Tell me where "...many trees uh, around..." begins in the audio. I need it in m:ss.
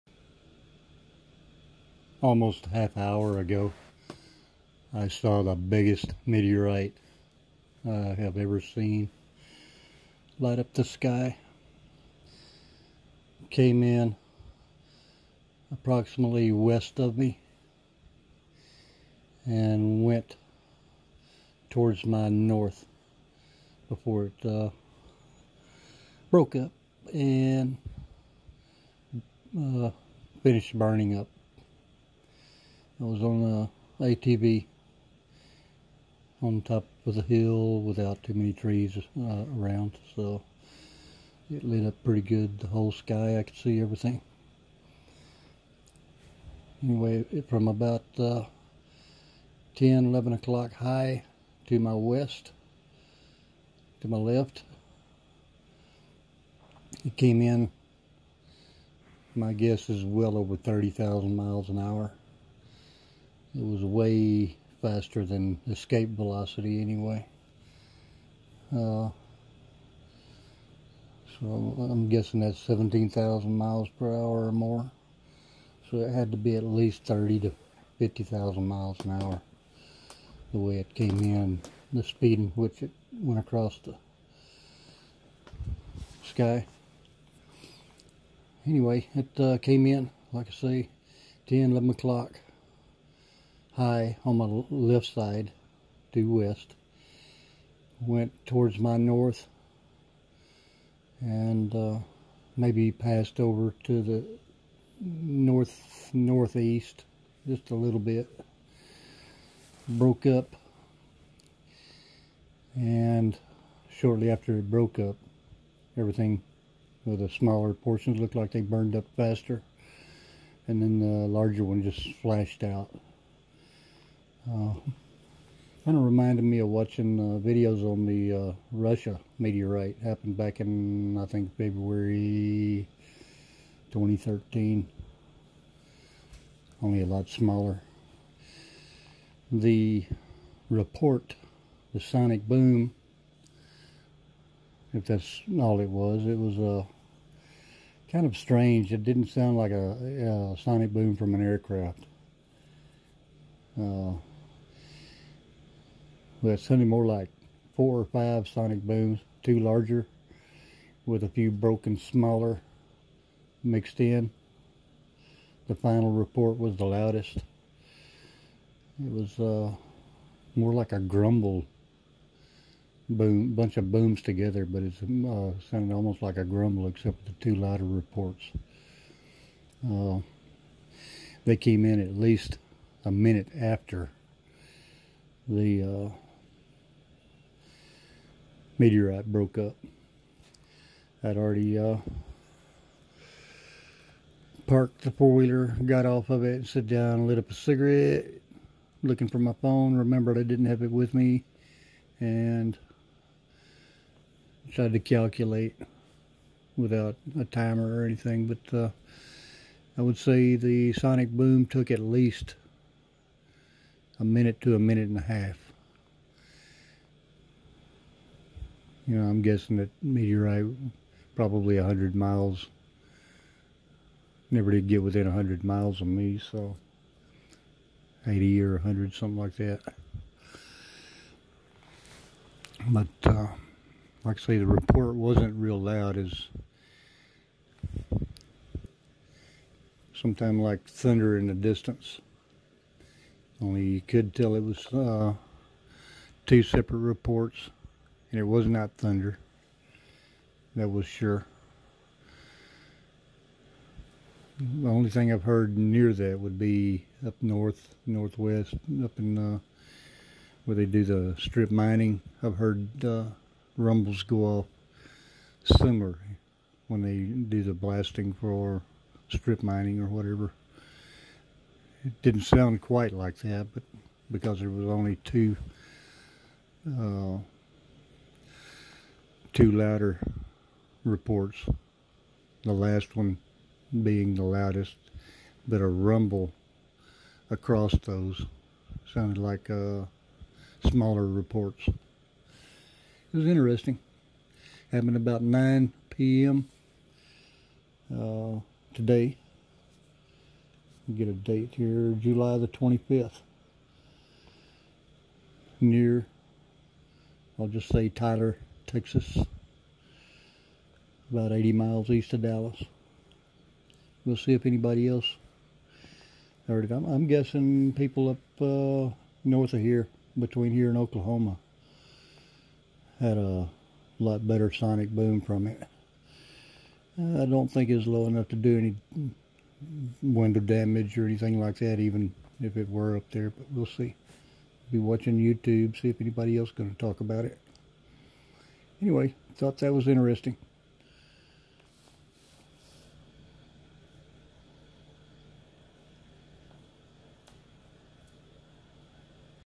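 0:38.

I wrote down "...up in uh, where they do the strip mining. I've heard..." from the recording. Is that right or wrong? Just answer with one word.
right.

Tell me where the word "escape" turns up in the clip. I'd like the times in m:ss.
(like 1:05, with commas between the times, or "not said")
1:05.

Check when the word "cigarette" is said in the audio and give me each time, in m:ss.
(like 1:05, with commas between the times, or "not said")
3:17.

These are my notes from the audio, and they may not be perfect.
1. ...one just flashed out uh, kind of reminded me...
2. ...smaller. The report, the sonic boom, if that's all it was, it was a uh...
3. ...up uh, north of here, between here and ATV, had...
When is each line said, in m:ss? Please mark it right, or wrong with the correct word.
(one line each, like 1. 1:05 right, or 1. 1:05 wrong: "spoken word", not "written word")
1. 2:01 right
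2. 2:17 right
3. 5:18 wrong: "Oklahoma", not "ATV".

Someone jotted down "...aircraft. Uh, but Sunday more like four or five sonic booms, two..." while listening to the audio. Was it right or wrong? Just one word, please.
right.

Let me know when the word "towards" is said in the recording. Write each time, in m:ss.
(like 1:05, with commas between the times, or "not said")
0:21, 1:38.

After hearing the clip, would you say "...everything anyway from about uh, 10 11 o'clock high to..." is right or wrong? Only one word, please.
right.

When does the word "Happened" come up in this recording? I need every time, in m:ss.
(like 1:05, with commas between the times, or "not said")
2:10, 4:54.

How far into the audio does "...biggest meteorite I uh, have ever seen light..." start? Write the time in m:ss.
0:05.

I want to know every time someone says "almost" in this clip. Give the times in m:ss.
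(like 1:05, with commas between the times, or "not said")
0:02, 2:55.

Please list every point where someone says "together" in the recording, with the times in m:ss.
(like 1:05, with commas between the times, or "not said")
2:54.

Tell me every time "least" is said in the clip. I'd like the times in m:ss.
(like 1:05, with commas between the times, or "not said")
1:16, 3:02, 3:31.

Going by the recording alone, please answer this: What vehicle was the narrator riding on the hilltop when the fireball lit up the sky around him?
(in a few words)
ATV.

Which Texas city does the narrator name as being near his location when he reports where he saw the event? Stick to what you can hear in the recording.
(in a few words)
Tyler.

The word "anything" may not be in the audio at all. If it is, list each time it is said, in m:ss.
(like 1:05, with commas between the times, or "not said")
3:28, 5:31.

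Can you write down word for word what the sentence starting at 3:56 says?
Is sometime like thunder in the distance.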